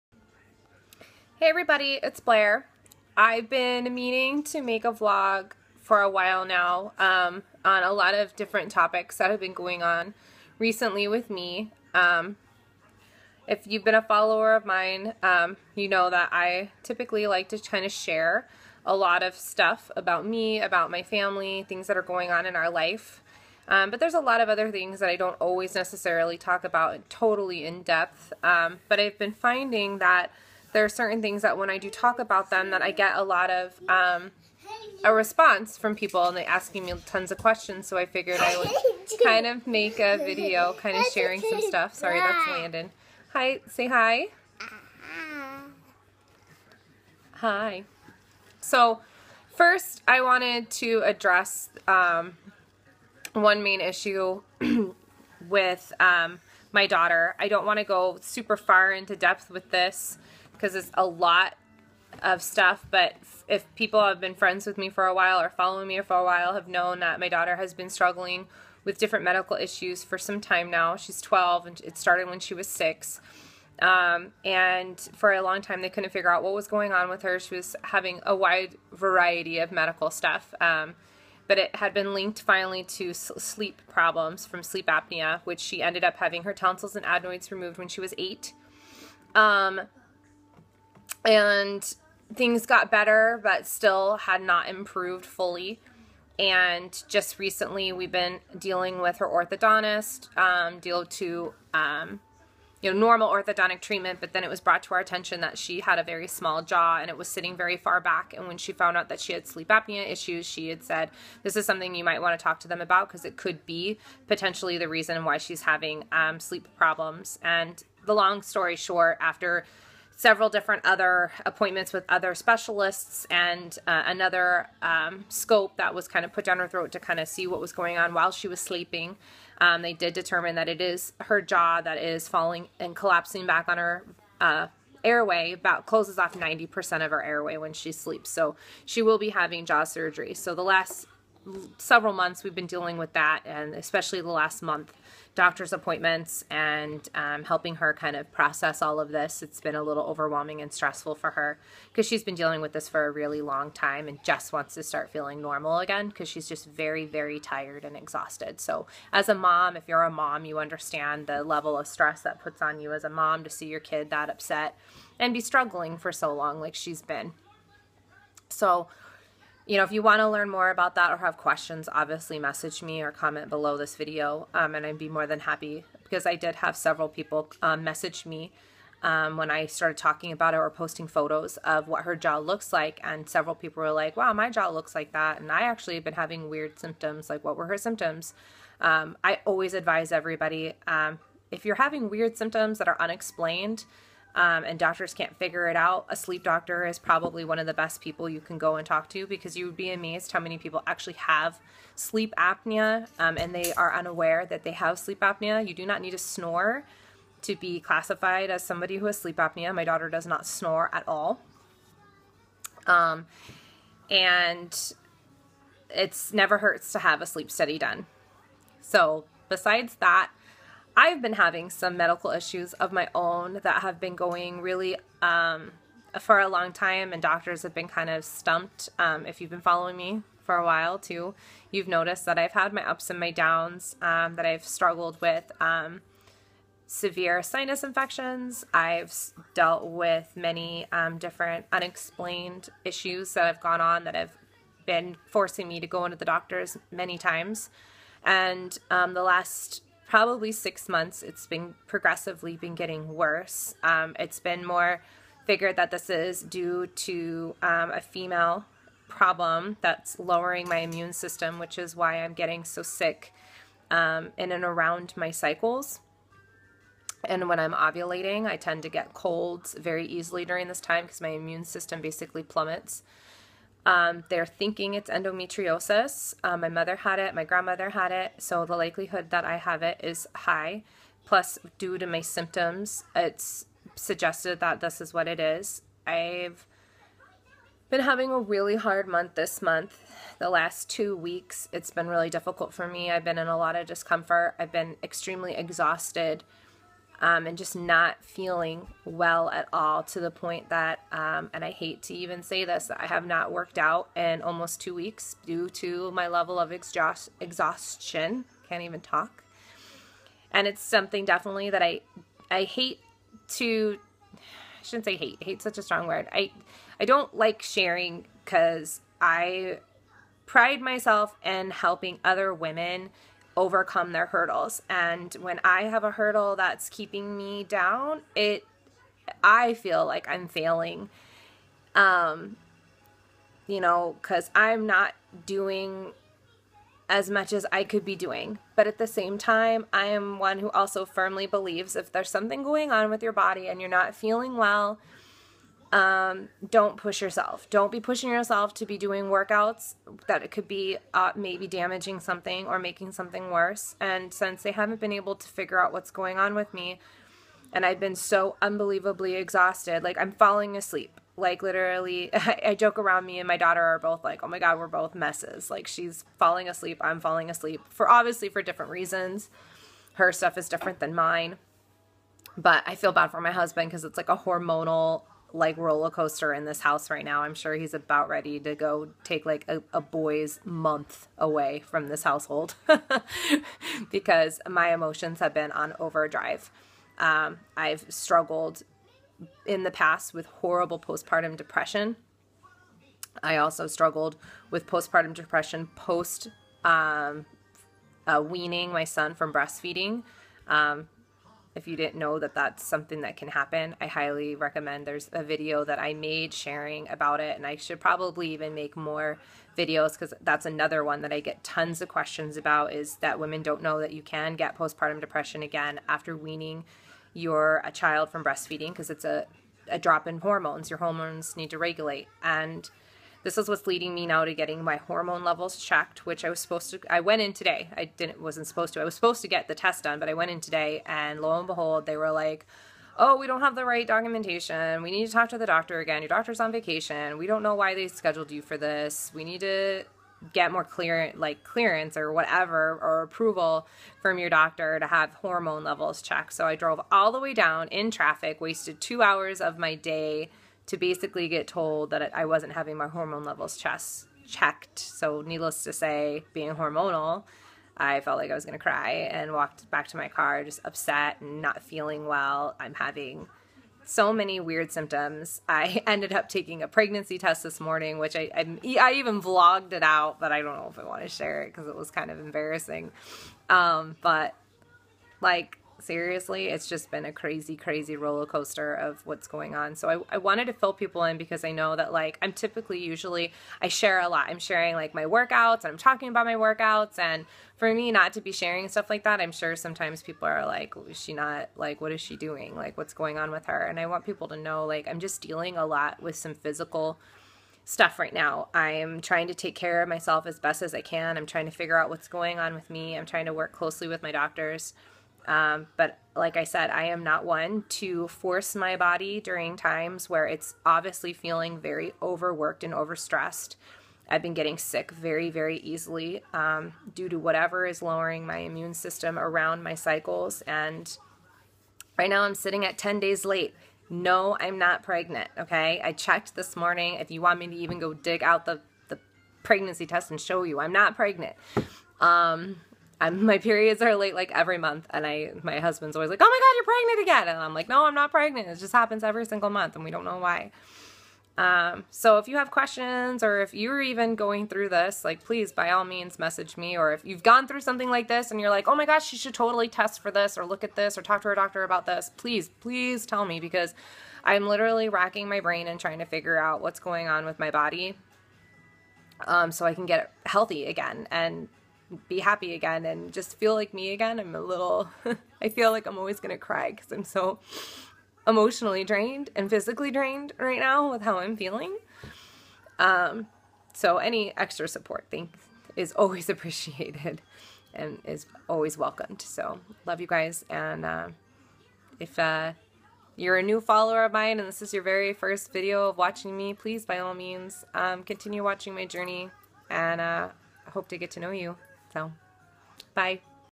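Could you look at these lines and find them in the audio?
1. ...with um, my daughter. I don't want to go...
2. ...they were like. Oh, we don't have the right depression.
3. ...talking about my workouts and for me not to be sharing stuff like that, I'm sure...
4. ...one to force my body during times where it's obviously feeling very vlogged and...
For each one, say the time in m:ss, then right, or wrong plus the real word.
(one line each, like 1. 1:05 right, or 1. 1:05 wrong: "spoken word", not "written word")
1. 0:55 right
2. 7:12 wrong: "documentation", not "depression"
3. 8:05 right
4. 8:27 wrong: "overworked", not "vlogged".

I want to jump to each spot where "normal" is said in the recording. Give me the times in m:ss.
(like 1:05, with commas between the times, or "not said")
1:42, 2:35.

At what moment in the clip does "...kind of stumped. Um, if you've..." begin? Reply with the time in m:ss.
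3:47.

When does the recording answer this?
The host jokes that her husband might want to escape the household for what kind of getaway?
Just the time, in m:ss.
6:20.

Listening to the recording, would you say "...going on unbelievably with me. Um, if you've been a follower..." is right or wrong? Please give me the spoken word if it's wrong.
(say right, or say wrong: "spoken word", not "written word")
wrong: "recently", not "unbelievably".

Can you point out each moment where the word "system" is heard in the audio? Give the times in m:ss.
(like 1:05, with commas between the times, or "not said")
4:21, 4:31, 8:38.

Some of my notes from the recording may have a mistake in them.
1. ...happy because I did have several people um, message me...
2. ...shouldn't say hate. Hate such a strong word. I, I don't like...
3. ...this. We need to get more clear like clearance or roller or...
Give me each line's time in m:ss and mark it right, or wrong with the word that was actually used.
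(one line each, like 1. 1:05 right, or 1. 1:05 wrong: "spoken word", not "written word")
1. 2:55 right
2. 5:14 right
3. 7:18 wrong: "whatever", not "roller".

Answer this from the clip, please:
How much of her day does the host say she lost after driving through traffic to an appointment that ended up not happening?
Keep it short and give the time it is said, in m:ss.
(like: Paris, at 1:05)
2 hours, at 7:29.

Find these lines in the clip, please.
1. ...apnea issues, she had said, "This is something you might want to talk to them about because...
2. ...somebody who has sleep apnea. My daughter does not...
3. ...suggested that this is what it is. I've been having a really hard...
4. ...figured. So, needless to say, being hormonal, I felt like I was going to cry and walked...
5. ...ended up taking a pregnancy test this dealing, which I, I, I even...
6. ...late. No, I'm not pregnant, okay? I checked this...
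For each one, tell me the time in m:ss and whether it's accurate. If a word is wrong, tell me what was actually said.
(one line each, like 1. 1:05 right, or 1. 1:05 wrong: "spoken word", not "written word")
1. 1:49 right
2. 3:28 right
3. 4:43 right
4. 7:34 wrong: "checked", not "figured"
5. 7:46 wrong: "morning", not "dealing"
6. 8:43 right.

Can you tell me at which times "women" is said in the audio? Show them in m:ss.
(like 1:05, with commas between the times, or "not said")
5:22, 6:53.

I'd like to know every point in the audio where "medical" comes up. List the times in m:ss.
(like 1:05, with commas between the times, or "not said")
1:09, 1:19, 3:41.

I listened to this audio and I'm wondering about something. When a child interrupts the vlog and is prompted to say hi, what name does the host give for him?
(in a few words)
Landon.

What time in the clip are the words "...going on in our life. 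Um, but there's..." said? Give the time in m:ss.
0:22.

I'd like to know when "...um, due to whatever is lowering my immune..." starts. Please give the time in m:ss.
8:36.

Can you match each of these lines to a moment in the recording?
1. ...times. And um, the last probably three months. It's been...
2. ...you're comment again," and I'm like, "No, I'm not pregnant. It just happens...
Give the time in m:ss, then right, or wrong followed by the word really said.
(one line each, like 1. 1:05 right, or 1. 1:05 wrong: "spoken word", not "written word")
1. 4:07 wrong: "six", not "three"
2. 8:56 wrong: "pregnant", not "comment".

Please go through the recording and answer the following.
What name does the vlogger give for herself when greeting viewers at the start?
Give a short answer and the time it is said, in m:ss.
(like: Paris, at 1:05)
Blair, at 0:02.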